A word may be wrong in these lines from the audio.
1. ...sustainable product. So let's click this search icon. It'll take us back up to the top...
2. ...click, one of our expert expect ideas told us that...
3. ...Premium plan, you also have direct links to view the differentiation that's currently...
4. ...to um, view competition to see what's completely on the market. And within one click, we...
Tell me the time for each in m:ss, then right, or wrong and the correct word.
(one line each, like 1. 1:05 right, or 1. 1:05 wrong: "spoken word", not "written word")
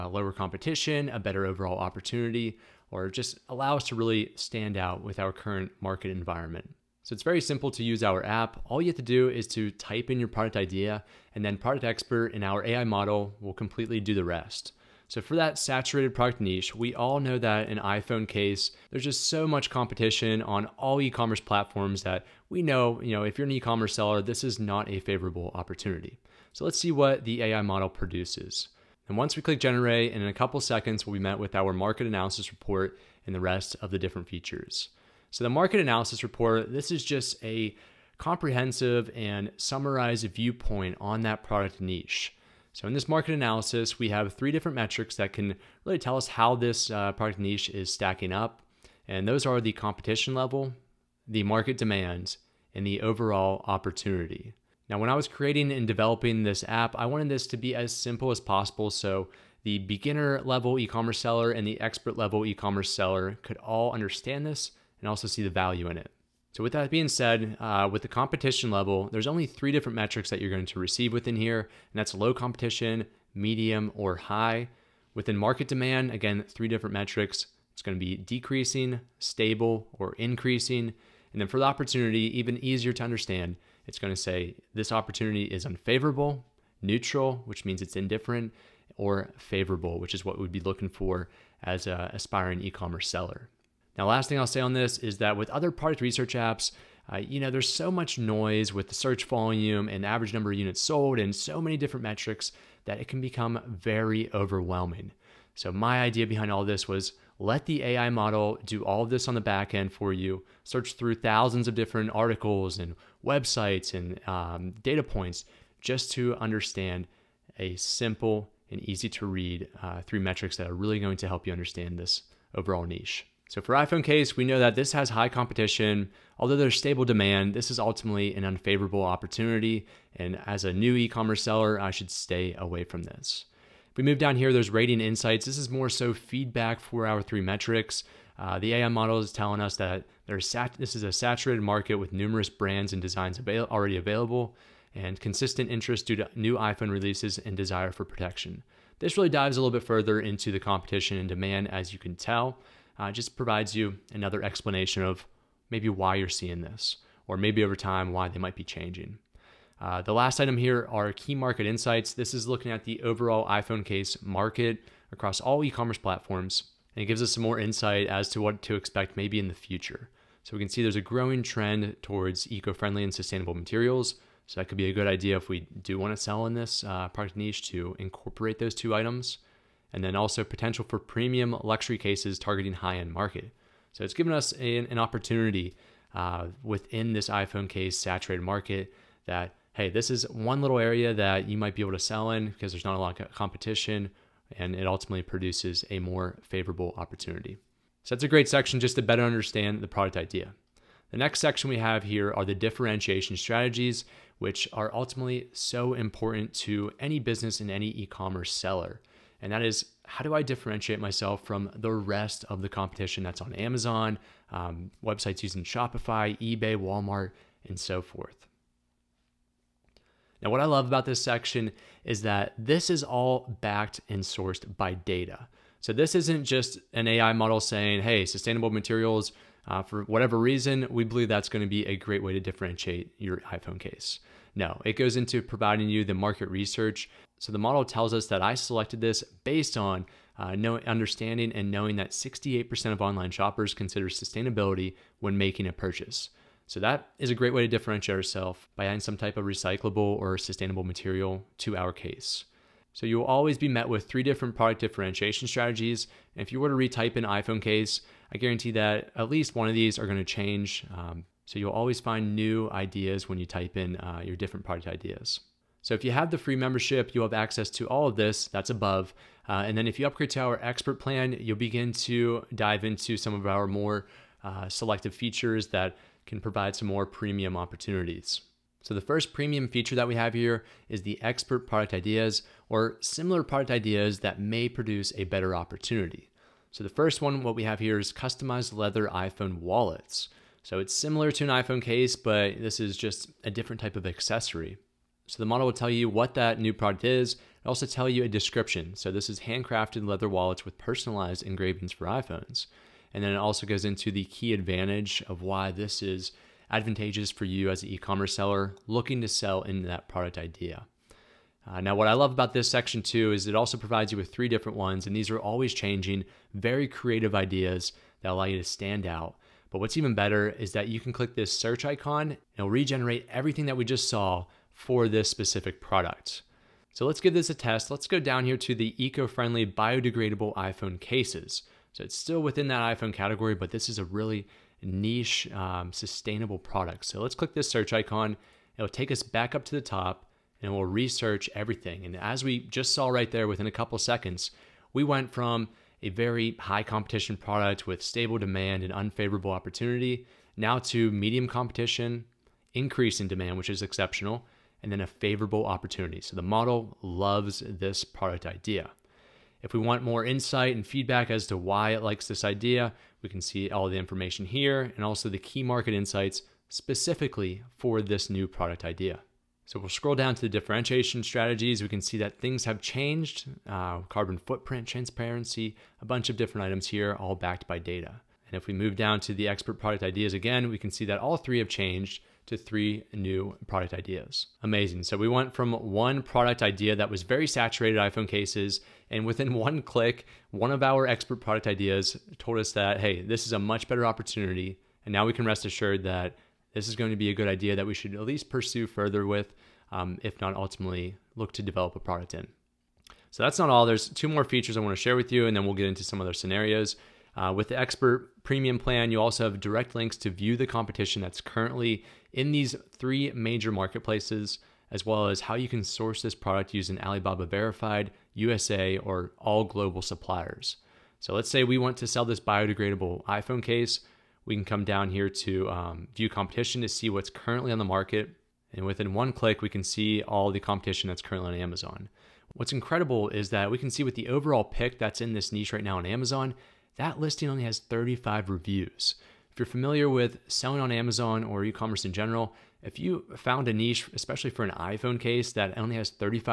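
1. 5:35 right
2. 6:29 wrong: "product", not "expect"
3. 6:48 wrong: "competition", not "differentiation"
4. 7:05 wrong: "currently", not "completely".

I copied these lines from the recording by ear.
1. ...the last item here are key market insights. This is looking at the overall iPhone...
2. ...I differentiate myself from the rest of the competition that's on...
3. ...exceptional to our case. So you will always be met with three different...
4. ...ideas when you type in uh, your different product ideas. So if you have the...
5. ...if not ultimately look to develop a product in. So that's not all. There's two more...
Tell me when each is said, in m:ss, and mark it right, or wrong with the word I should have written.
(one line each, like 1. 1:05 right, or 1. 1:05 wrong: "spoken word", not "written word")
1. 2:40 right
2. 3:30 right
3. 4:10 wrong: "material", not "exceptional"
4. 4:22 right
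5. 6:40 right.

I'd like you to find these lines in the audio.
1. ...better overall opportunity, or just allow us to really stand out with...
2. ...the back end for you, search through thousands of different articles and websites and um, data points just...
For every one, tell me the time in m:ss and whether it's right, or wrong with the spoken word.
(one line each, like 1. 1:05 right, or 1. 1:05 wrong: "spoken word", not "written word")
1. 0:01 right
2. 1:49 right.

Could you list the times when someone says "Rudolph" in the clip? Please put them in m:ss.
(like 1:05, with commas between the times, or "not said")
not said.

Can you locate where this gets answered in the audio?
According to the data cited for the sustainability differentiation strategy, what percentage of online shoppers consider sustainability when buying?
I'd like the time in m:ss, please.
4:02.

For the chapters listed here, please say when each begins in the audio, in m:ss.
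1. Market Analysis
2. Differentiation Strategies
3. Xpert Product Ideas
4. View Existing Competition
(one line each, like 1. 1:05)
1. 0:34
2. 3:10
3. 4:25
4. 6:43.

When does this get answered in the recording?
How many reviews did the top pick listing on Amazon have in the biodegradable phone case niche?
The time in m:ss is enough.
7:17.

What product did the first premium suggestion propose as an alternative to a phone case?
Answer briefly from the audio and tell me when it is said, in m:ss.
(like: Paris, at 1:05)
customized leather iPhone wallets, at 4:48.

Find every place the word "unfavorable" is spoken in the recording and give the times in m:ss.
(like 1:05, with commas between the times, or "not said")
1:25, 2:08, 5:48.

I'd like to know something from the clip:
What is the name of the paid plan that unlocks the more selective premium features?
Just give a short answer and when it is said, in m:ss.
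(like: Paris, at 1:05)
expert plan, at 4:30.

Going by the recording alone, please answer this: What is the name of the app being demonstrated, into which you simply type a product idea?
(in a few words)
productXpert.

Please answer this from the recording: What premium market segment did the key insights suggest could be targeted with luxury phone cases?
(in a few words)
high-end market.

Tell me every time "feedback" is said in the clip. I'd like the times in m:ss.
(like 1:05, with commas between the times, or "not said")
2:16, 6:00.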